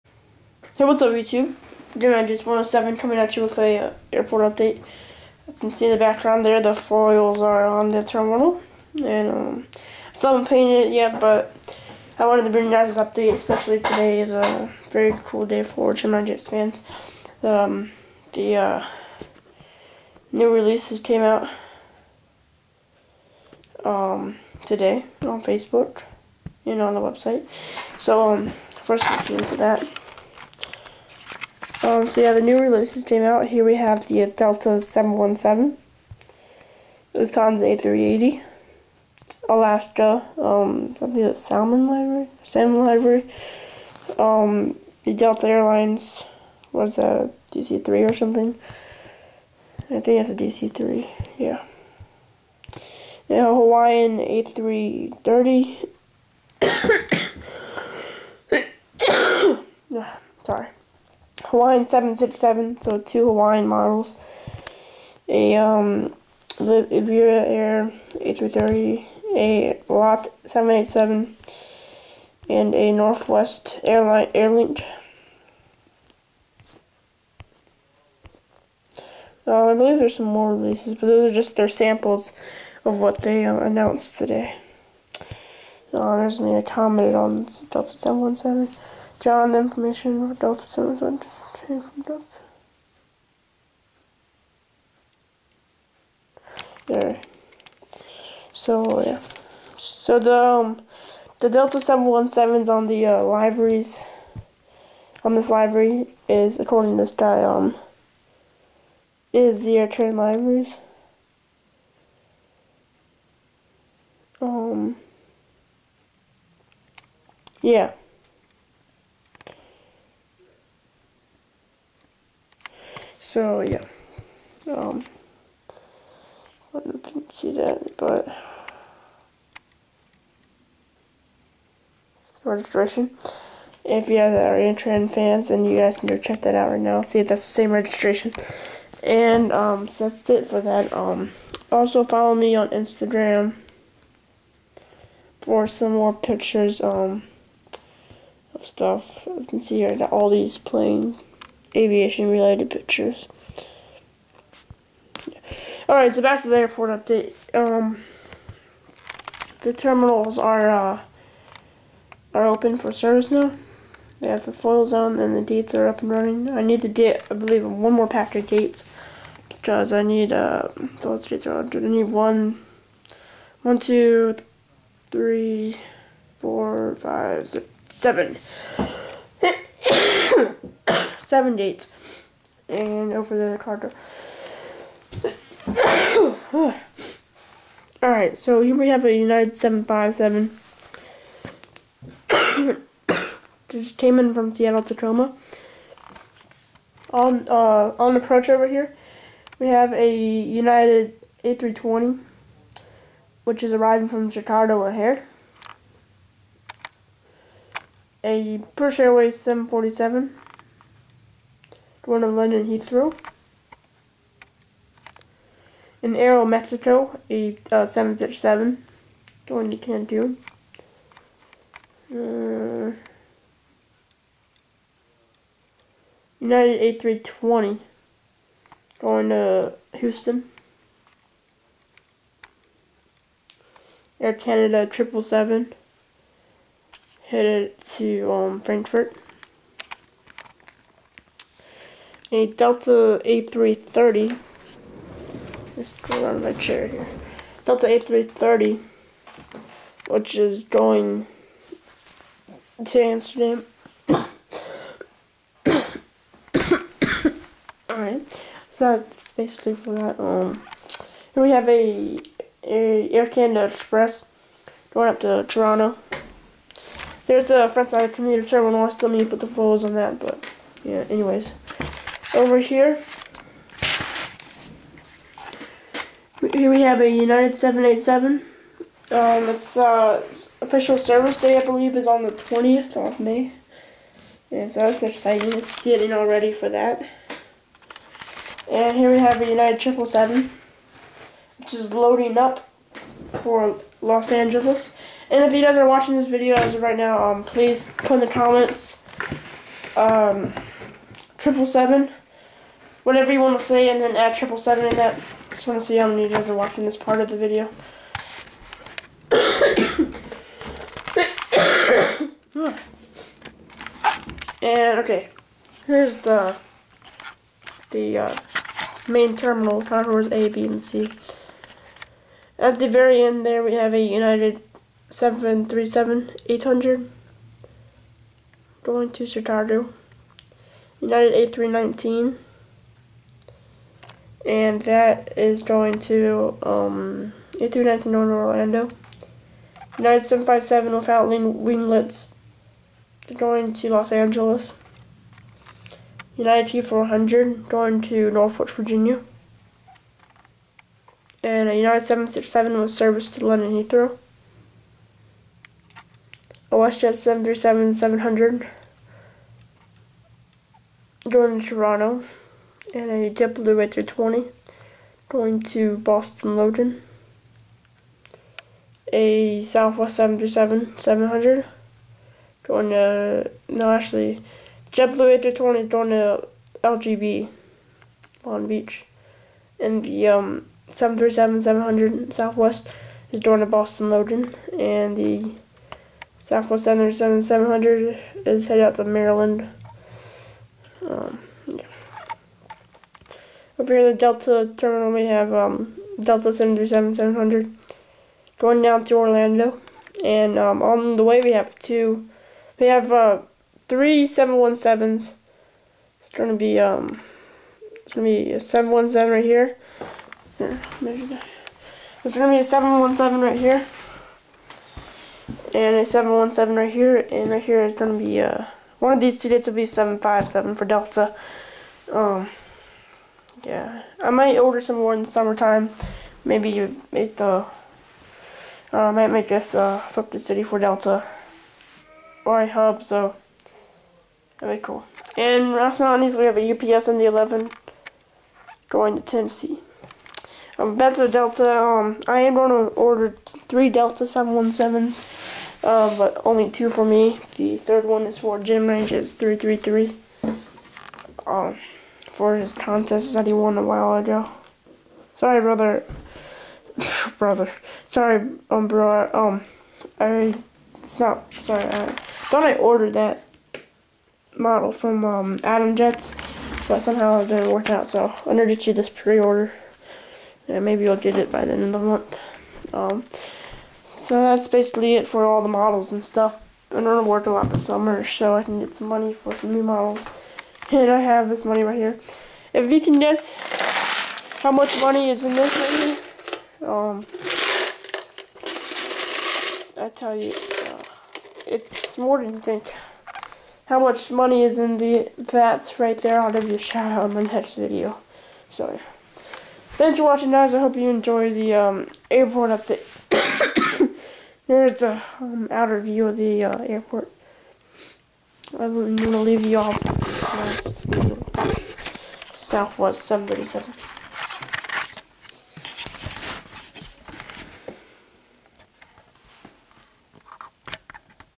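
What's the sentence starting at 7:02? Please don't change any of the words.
Um, yeah, I might order some more in the summertime.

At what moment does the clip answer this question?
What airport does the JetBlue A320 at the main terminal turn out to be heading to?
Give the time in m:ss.
6:18.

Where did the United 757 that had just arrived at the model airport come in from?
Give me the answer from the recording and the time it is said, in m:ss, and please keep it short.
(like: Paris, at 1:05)
Seattle Tacoma, at 3:14.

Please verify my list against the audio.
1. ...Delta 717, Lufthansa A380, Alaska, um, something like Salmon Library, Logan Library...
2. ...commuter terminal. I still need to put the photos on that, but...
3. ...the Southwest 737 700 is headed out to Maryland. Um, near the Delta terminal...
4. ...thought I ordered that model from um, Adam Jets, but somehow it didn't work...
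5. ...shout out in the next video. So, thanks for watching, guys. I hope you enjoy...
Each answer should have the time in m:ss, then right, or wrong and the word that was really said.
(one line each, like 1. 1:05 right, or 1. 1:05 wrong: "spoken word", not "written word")
1. 0:34 wrong: "Salmon", not "Logan"
2. 4:28 right
3. 6:25 right
4. 7:42 right
5. 8:16 right.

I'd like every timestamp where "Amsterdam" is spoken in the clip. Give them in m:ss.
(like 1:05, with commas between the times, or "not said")
4:13.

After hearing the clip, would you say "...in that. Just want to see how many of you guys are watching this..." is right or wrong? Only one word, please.
right.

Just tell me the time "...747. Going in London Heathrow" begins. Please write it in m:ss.
3:29.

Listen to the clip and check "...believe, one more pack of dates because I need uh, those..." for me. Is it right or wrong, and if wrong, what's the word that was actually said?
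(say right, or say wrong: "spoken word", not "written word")
right.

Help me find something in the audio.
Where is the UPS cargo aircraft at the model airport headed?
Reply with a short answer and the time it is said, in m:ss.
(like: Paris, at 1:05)
Tennessee, at 7:19.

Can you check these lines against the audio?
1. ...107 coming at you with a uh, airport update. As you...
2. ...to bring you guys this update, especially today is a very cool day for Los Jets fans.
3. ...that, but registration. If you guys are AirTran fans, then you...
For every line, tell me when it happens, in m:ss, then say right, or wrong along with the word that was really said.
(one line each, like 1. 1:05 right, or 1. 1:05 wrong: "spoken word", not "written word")
1. 0:02 right
2. 0:12 wrong: "Gemini", not "Los"
3. 2:07 right.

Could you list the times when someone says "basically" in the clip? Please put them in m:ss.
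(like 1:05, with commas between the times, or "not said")
4:19, 7:54.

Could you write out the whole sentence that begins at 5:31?
United A319 and that is going to um, e to Northern Orlando.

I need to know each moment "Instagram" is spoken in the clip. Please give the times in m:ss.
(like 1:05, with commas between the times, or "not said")
2:22.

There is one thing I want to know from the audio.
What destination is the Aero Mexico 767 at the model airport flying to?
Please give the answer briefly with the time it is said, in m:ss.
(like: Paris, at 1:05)
Cancun, at 3:39.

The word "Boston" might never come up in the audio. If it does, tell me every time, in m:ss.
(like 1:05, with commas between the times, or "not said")
6:05, 6:23.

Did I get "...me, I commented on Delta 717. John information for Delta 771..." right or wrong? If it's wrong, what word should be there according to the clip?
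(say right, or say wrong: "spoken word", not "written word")
wrong: "772", not "771".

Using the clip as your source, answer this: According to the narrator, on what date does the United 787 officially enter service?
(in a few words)
20th of May.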